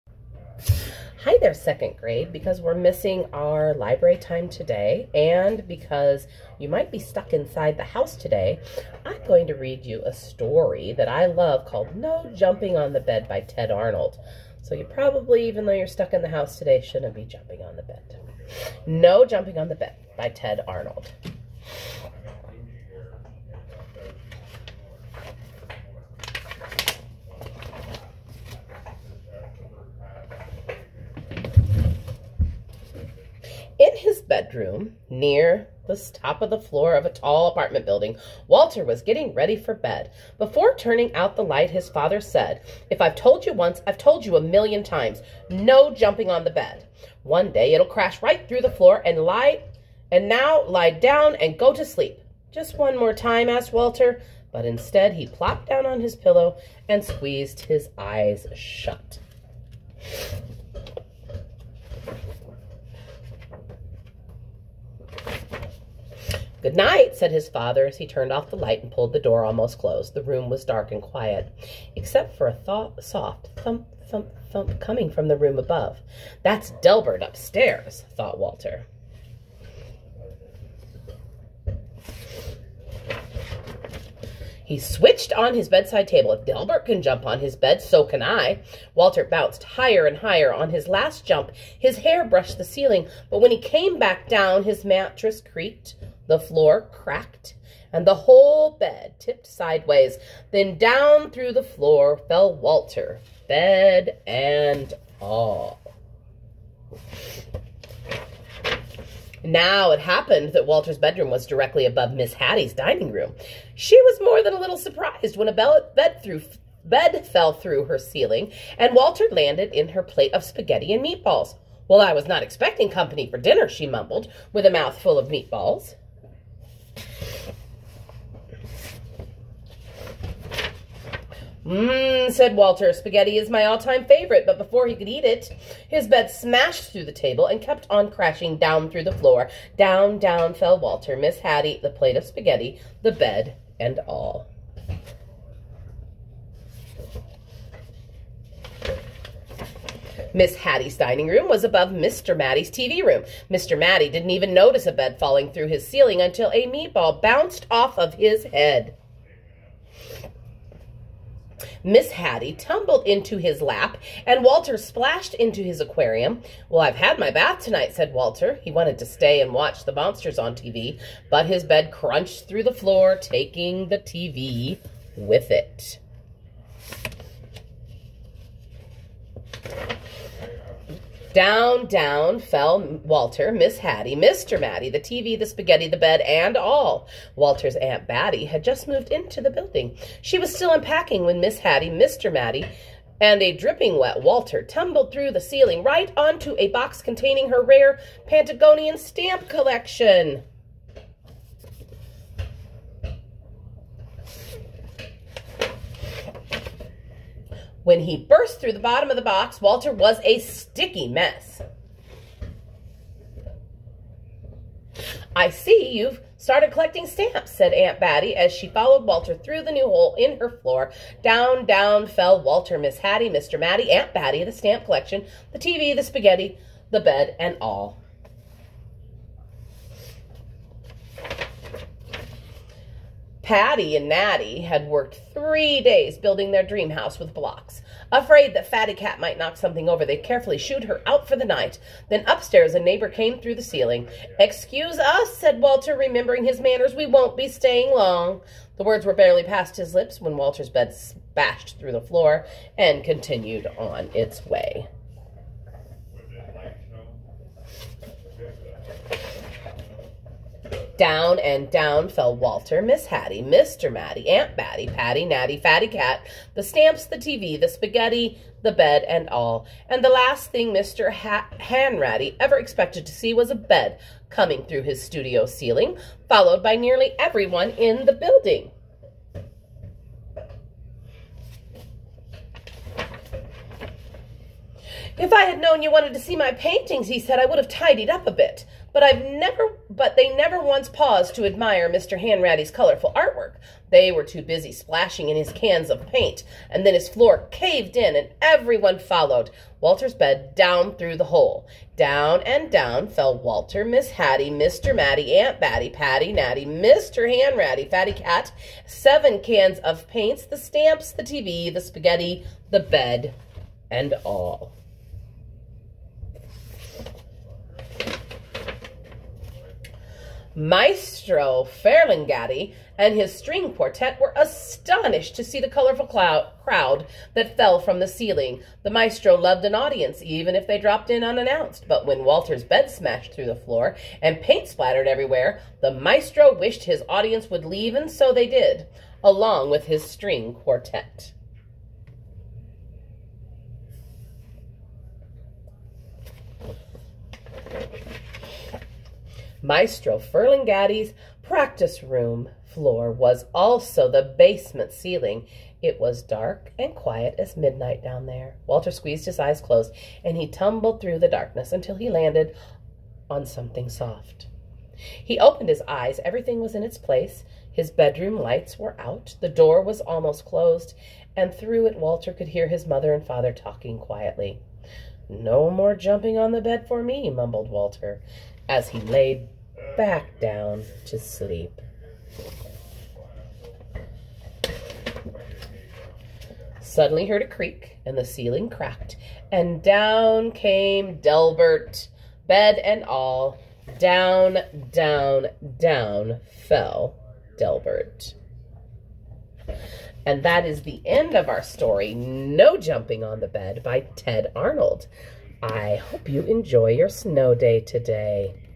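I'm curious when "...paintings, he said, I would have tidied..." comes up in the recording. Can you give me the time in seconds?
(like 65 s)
286 s.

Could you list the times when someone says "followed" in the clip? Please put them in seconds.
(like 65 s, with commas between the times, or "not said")
218 s, 276 s, 298 s.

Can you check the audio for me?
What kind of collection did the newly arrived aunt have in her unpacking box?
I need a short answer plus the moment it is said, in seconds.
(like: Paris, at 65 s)
Pantagonian stamp collection, at 198 s.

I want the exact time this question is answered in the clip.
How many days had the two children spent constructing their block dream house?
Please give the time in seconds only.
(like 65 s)
235 s.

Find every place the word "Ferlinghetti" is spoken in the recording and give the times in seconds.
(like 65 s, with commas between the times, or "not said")
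321 s, 350 s.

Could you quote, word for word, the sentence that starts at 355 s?
It was dark and quiet as midnight down there.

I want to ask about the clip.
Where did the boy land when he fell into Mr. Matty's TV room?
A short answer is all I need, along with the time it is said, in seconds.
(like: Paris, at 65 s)
his aquarium, at 165 s.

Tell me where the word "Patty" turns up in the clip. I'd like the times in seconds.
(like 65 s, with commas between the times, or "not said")
233 s, 264 s, 305 s.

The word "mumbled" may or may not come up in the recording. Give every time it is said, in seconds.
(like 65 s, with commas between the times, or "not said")
123 s, 377 s.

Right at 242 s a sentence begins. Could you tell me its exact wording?
Then upstairs, a neighbor came through the ceiling.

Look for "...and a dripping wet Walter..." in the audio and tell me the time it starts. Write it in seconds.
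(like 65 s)
193 s.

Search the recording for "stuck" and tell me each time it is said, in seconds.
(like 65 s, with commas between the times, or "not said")
6 s, 15 s.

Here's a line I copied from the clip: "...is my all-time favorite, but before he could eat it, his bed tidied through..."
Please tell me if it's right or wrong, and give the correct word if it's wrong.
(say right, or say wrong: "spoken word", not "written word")
wrong: "smashed", not "tidied".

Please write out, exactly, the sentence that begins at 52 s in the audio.
Just one more time, asked Walter, but instead he plopped down on his pillow and squeezed his eyes shut.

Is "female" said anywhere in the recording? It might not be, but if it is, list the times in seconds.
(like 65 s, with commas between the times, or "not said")
not said.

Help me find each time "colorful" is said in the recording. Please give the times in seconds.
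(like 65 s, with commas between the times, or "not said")
292 s, 325 s.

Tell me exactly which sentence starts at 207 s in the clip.
When he burst through the bottom of the box, Walter was a sticky mess.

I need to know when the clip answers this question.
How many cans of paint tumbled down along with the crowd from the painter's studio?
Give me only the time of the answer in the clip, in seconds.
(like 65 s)
308 s.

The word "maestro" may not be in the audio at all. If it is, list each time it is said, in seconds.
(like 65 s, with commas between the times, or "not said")
320 s, 328 s, 335 s, 349 s.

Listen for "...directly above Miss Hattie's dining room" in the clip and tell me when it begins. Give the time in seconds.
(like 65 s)
111 s.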